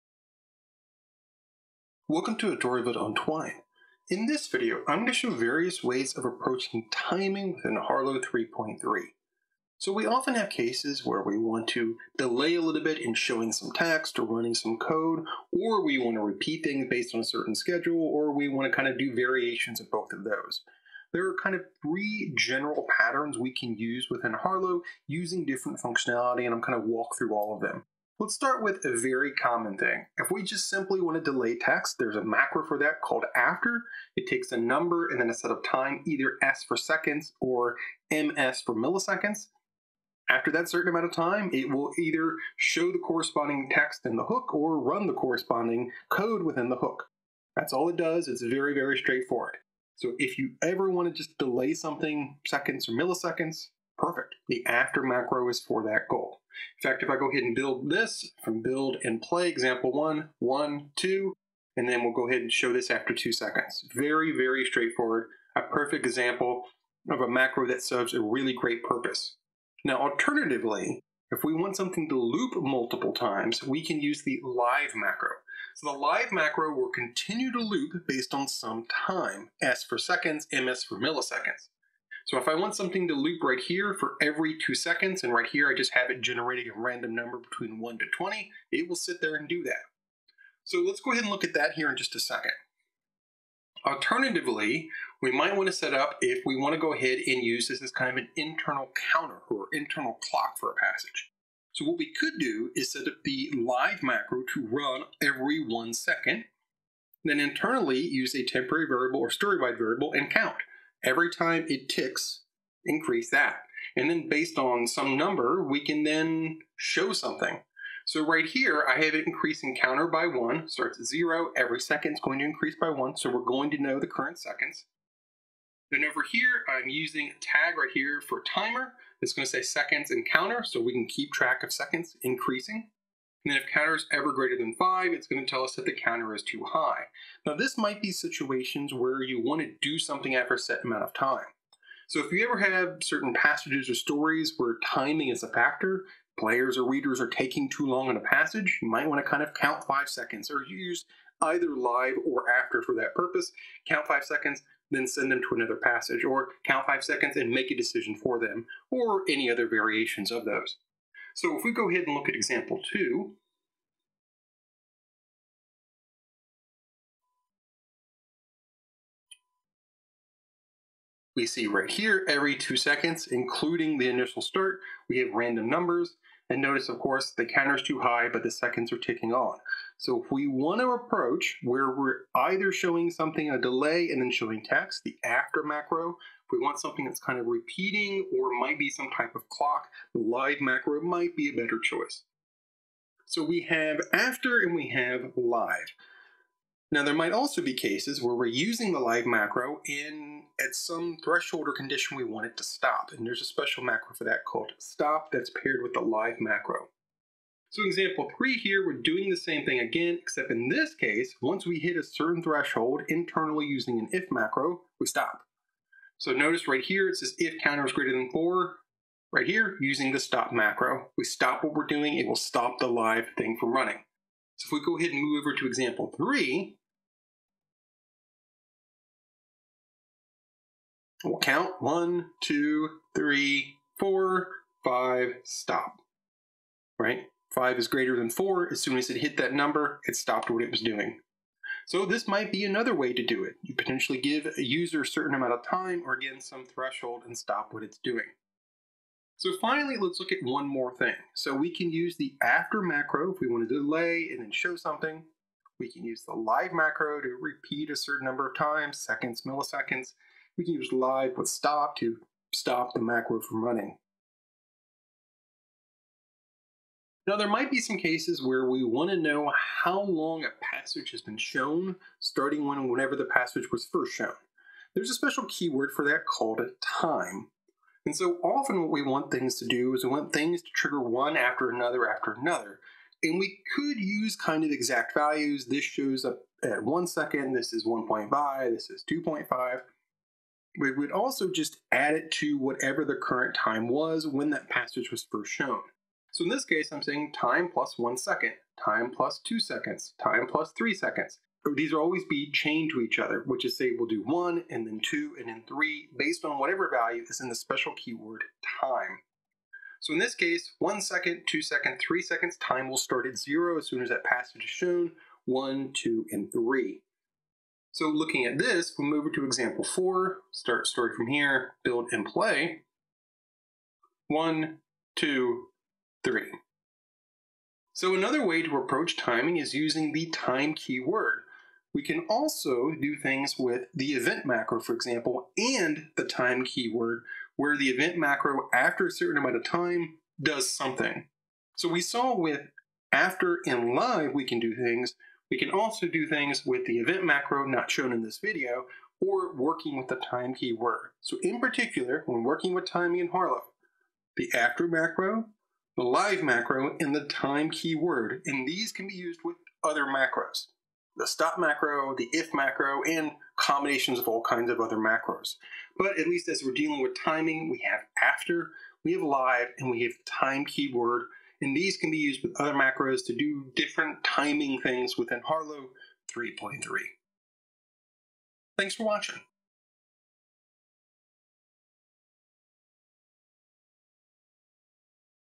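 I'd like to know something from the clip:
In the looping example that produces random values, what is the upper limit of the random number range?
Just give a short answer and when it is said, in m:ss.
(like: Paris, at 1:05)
20, at 1:28.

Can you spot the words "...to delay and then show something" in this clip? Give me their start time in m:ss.
4:13.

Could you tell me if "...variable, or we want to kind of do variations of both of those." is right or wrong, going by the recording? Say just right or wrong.
wrong.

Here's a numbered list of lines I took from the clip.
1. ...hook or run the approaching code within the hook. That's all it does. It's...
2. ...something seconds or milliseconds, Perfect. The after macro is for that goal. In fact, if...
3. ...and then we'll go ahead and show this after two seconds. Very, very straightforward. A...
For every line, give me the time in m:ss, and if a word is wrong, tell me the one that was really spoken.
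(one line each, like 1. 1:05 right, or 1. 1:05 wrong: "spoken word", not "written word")
1. 0:44 wrong: "corresponding", not "approaching"
2. 0:51 right
3. 1:01 right.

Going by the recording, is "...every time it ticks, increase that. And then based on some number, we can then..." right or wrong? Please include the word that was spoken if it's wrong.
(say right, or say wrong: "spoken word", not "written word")
right.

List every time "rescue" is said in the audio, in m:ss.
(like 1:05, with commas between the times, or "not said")
not said.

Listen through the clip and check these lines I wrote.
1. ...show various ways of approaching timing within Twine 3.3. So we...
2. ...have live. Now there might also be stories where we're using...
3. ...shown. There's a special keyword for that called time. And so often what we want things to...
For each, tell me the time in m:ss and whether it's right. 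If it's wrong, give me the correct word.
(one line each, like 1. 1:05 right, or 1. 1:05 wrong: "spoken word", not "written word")
1. 0:05 wrong: "Harlowe", not "Twine"
2. 3:14 wrong: "cases", not "stories"
3. 4:34 right.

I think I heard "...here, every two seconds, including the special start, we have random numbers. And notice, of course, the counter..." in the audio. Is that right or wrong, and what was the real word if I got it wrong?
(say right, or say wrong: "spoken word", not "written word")
wrong: "initial", not "special".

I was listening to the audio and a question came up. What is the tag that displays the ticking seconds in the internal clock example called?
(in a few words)
timer.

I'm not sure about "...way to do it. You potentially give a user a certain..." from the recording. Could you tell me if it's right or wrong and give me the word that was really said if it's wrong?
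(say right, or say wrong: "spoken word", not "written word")
right.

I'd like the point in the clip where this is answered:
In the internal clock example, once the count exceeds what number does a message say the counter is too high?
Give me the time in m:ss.
2:14.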